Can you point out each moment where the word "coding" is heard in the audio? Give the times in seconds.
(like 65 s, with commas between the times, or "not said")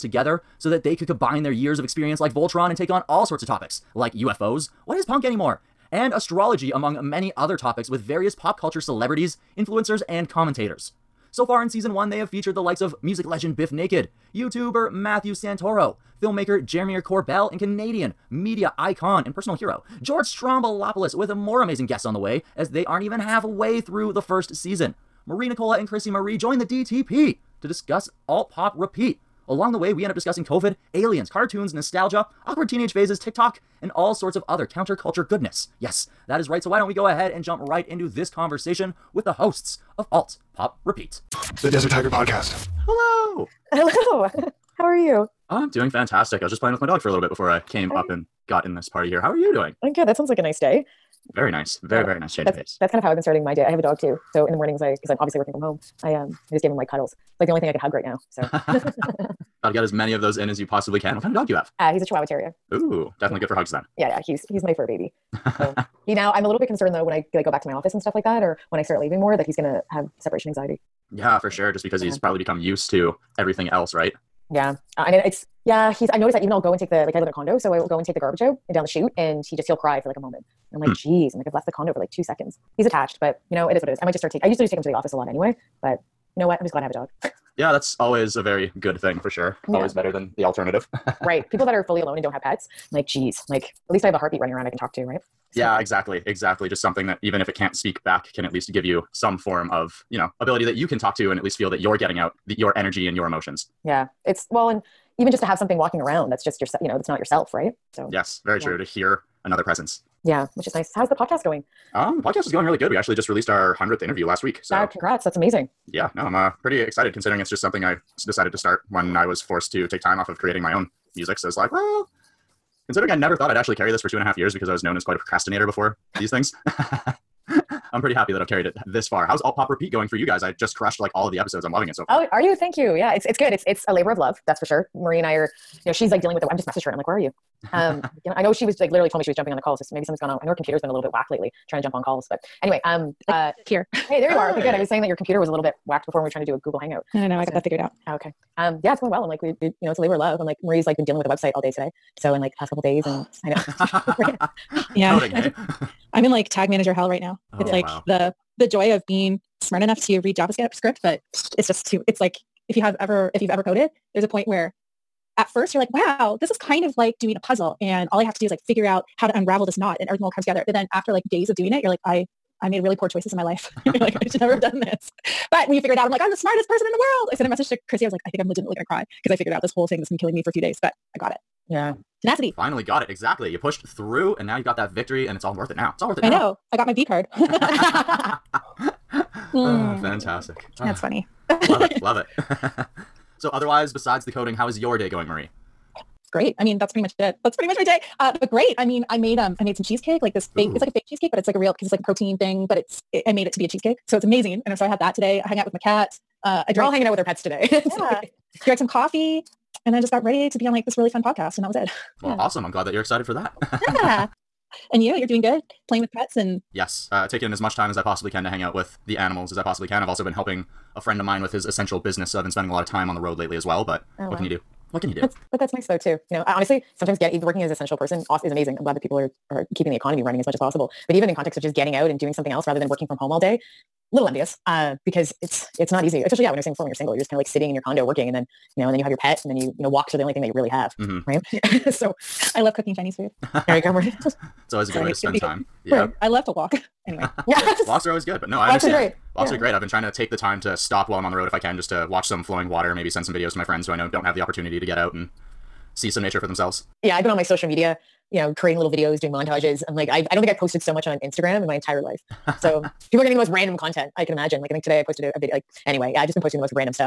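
155 s, 194 s.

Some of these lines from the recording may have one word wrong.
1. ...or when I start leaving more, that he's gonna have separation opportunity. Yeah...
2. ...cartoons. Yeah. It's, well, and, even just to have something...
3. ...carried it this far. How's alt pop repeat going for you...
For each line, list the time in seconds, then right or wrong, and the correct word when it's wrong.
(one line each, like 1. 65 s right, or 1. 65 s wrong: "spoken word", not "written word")
1. 68 s wrong: "anxiety", not "opportunity"
2. 103 s wrong: "emotions", not "cartoons"
3. 128 s right.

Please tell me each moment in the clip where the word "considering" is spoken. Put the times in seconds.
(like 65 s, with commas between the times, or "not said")
117 s, 122 s.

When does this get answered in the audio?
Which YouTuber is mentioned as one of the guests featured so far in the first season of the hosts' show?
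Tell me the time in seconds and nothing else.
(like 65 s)
14 s.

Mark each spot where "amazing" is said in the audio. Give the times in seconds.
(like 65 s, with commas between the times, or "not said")
21 s, 115 s, 204 s, 228 s.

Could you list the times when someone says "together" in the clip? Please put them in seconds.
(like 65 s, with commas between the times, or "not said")
0 s, 170 s.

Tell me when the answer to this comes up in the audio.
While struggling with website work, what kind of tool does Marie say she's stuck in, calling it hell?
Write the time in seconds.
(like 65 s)
156 s.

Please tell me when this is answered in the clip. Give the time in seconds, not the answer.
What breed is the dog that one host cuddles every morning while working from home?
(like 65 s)
62 s.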